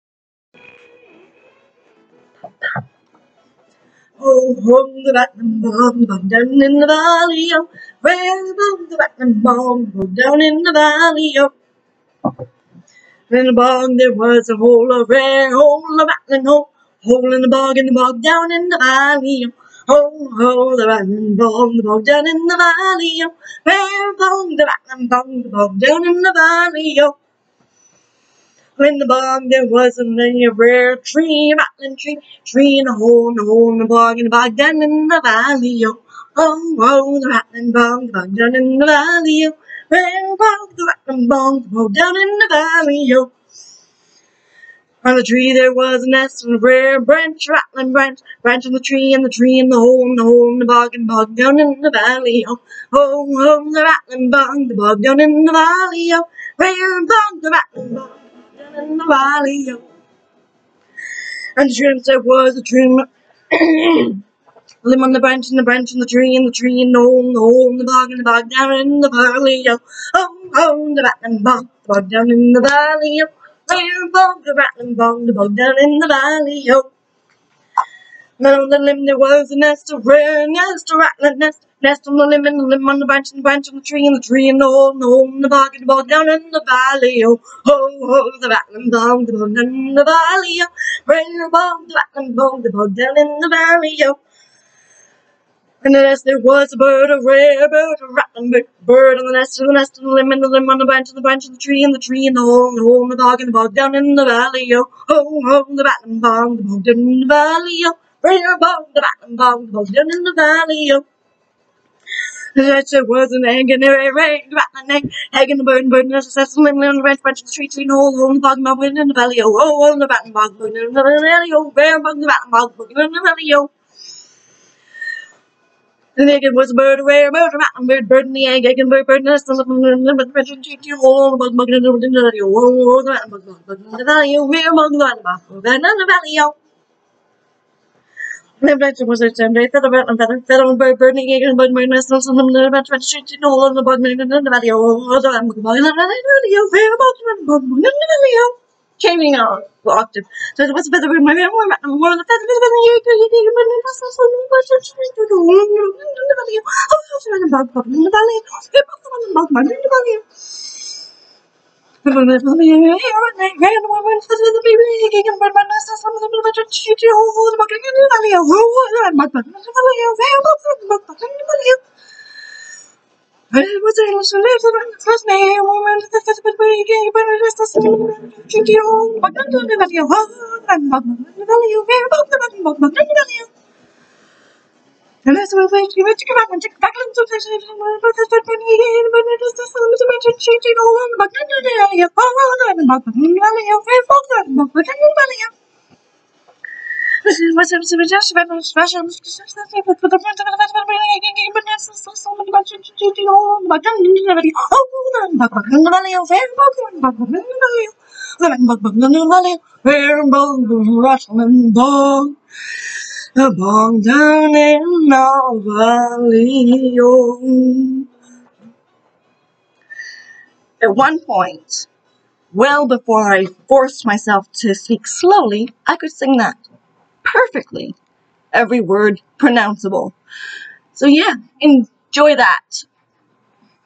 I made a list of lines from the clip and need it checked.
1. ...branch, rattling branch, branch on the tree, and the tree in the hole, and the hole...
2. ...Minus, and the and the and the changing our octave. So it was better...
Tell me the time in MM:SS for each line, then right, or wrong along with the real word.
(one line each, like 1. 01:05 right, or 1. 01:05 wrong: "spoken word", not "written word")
1. 00:47 right
2. 02:21 right.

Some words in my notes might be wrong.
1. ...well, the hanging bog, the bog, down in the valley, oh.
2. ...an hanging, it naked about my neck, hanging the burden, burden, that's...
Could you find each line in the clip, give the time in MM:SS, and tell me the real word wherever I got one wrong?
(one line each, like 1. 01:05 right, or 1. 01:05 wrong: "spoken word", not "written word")
1. 00:40 wrong: "rattling", not "hanging"
2. 01:53 wrong: "rained", not "naked".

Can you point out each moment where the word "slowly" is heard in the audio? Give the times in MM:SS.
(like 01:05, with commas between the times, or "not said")
03:45.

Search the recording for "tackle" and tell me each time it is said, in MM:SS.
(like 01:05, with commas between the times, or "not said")
not said.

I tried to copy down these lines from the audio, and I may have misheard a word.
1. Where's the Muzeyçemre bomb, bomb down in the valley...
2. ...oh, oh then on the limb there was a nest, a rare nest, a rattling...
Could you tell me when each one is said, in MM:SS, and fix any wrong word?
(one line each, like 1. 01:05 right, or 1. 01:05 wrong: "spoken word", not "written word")
1. 00:08 wrong: "Batman", not "Muzeyçemre"
2. 01:16 right.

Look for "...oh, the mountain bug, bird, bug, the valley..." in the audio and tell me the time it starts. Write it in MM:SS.
02:12.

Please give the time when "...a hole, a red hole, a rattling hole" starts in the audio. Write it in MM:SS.
00:14.